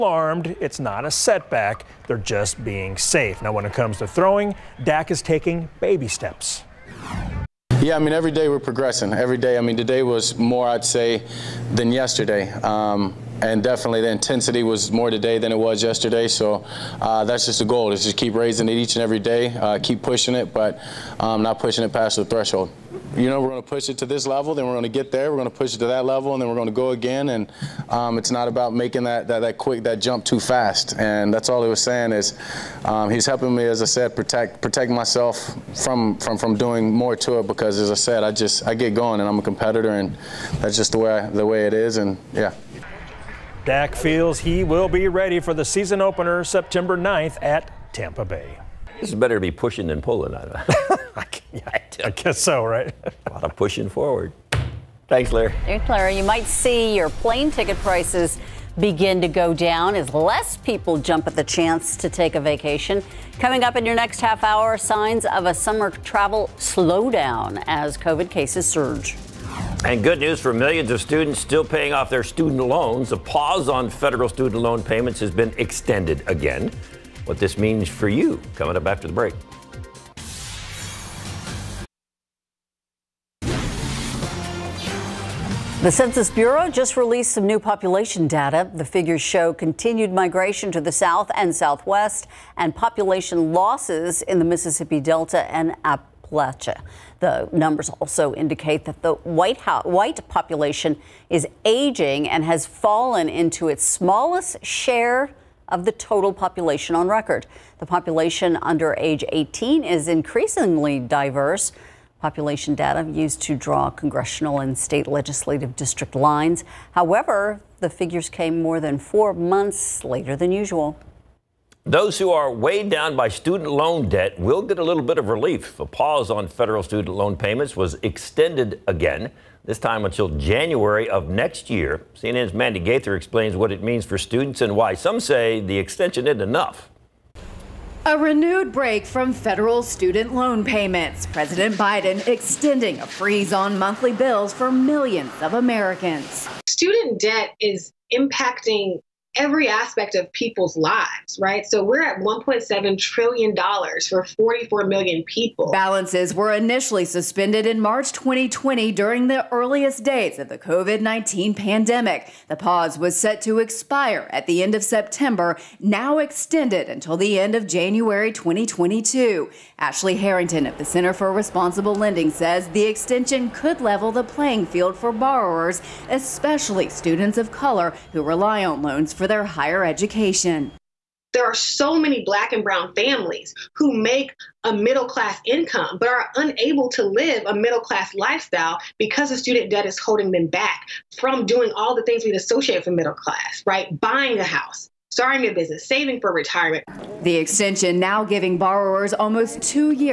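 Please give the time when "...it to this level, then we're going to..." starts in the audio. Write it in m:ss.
0:23.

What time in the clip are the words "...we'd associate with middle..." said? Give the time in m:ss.
3:12.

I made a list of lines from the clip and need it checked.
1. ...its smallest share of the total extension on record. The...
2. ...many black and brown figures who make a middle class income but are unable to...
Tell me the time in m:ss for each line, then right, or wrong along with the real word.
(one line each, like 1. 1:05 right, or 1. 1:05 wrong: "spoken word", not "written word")
1. 1:43 wrong: "population", not "extension"
2. 3:01 wrong: "families", not "figures".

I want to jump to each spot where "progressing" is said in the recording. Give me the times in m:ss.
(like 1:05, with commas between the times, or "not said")
0:08.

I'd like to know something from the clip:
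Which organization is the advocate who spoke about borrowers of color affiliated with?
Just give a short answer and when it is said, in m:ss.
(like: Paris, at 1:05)
Center for Responsible Lending, at 2:50.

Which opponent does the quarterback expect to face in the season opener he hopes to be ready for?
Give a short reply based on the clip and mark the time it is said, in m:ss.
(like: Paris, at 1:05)
Tampa Bay, at 0:47.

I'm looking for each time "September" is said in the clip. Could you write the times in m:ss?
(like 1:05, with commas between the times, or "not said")
0:46, 2:44.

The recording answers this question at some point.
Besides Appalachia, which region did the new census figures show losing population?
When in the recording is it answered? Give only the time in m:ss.
1:34.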